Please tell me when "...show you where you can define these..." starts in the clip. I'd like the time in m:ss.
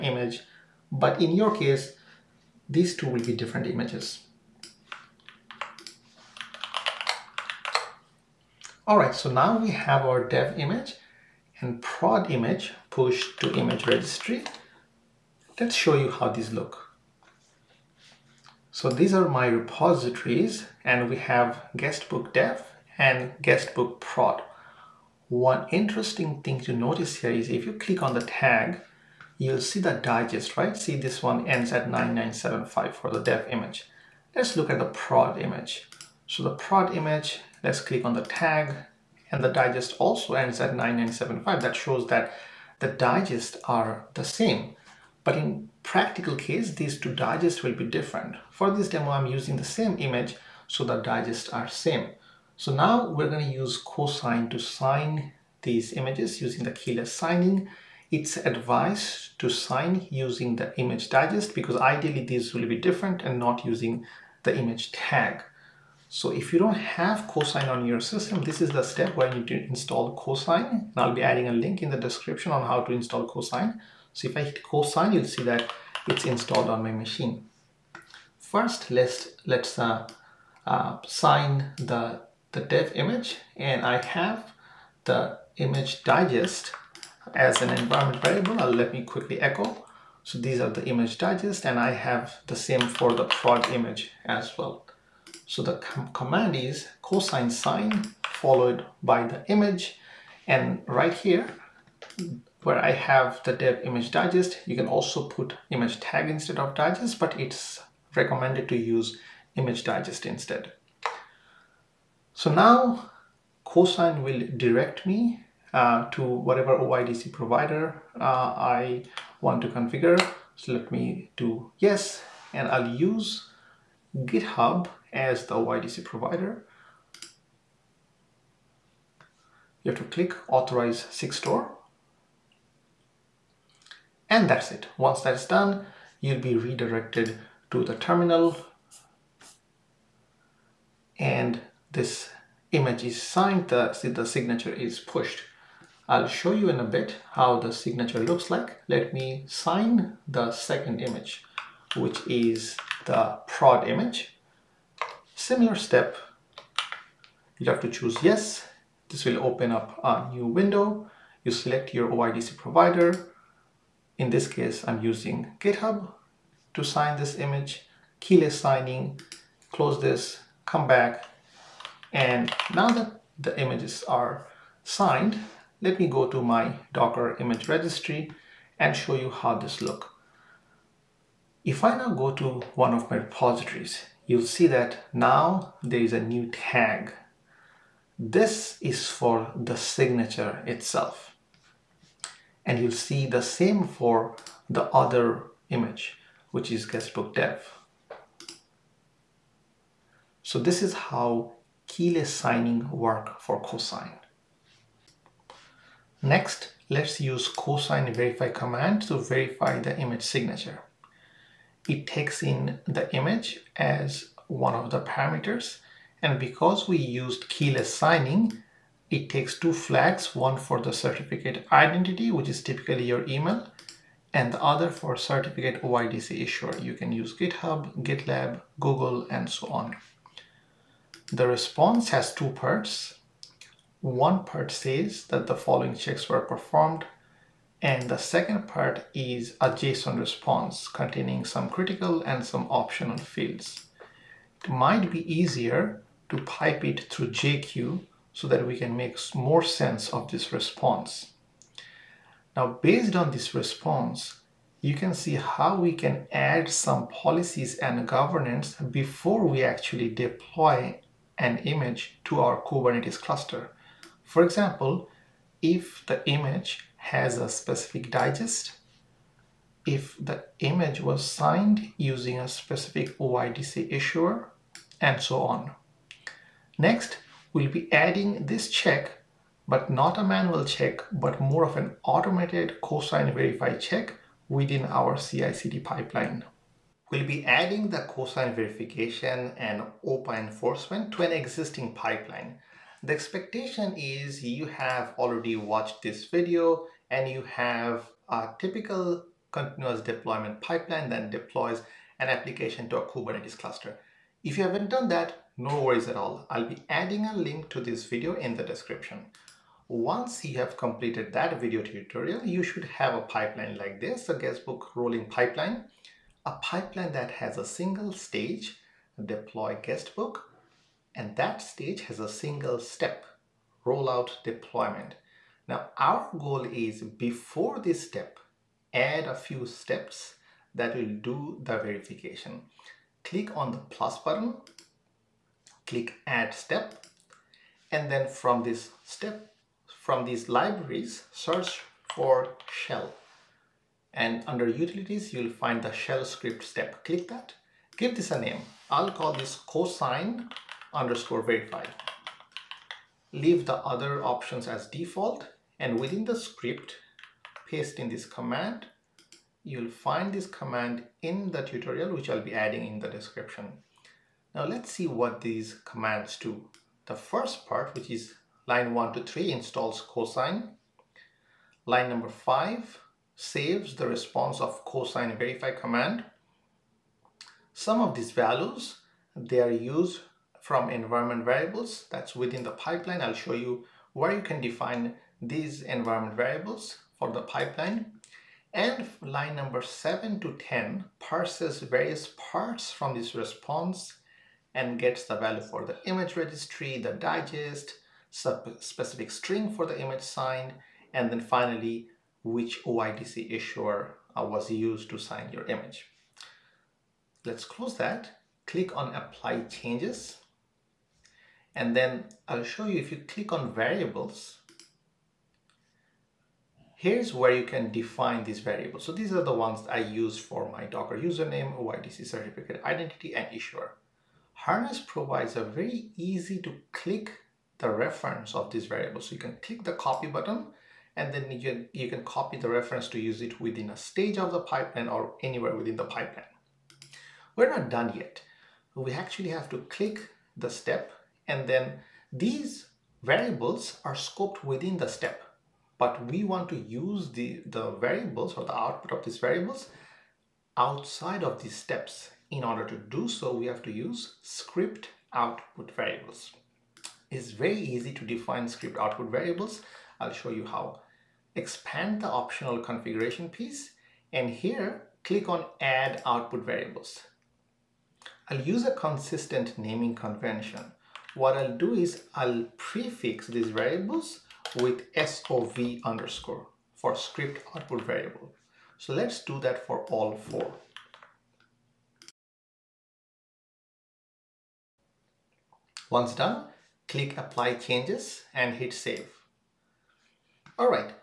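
6:23.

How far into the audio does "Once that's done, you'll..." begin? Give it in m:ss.
2:14.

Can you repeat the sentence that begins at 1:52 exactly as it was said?
So now cosign will direct me uh, to whatever OIDC provider uh, I want to configure.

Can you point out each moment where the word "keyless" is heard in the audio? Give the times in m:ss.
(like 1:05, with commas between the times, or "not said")
0:56, 2:48, 3:21, 3:37.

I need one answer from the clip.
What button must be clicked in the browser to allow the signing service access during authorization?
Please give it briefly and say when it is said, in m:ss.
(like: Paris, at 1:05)
Authorize Sigstore, at 2:10.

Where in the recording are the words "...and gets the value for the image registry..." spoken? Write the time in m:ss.
6:34.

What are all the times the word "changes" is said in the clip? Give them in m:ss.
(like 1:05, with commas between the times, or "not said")
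6:49, 8:07.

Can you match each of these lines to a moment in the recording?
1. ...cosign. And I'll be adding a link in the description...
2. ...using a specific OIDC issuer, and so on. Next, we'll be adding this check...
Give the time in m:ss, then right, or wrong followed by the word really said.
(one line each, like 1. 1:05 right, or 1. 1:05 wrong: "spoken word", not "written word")
1. 1:10 right
2. 4:31 right.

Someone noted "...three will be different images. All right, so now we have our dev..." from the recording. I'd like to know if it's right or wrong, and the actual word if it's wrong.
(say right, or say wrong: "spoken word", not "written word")
wrong: "two", not "three".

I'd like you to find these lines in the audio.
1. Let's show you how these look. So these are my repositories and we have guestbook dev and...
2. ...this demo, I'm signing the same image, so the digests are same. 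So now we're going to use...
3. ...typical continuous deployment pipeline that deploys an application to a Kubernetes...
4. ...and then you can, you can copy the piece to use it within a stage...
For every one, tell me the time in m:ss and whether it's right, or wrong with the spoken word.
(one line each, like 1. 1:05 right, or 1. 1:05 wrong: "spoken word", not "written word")
1. 0:15 right
2. 0:48 wrong: "using", not "signing"
3. 4:58 right
4. 7:11 wrong: "reference", not "piece".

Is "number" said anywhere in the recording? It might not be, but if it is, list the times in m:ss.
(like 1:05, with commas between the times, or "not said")
6:12, 6:29.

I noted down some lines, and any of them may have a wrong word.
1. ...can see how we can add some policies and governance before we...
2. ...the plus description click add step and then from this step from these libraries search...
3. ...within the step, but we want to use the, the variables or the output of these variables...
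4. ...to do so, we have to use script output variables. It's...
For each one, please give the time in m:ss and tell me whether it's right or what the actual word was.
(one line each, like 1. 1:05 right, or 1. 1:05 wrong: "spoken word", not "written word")
1. 4:14 right
2. 5:33 wrong: "button", not "description"
3. 7:24 right
4. 7:32 right.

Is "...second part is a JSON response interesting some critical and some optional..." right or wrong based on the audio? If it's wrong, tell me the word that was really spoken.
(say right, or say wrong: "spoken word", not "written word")
wrong: "containing", not "interesting".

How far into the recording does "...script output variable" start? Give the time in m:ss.
7:57.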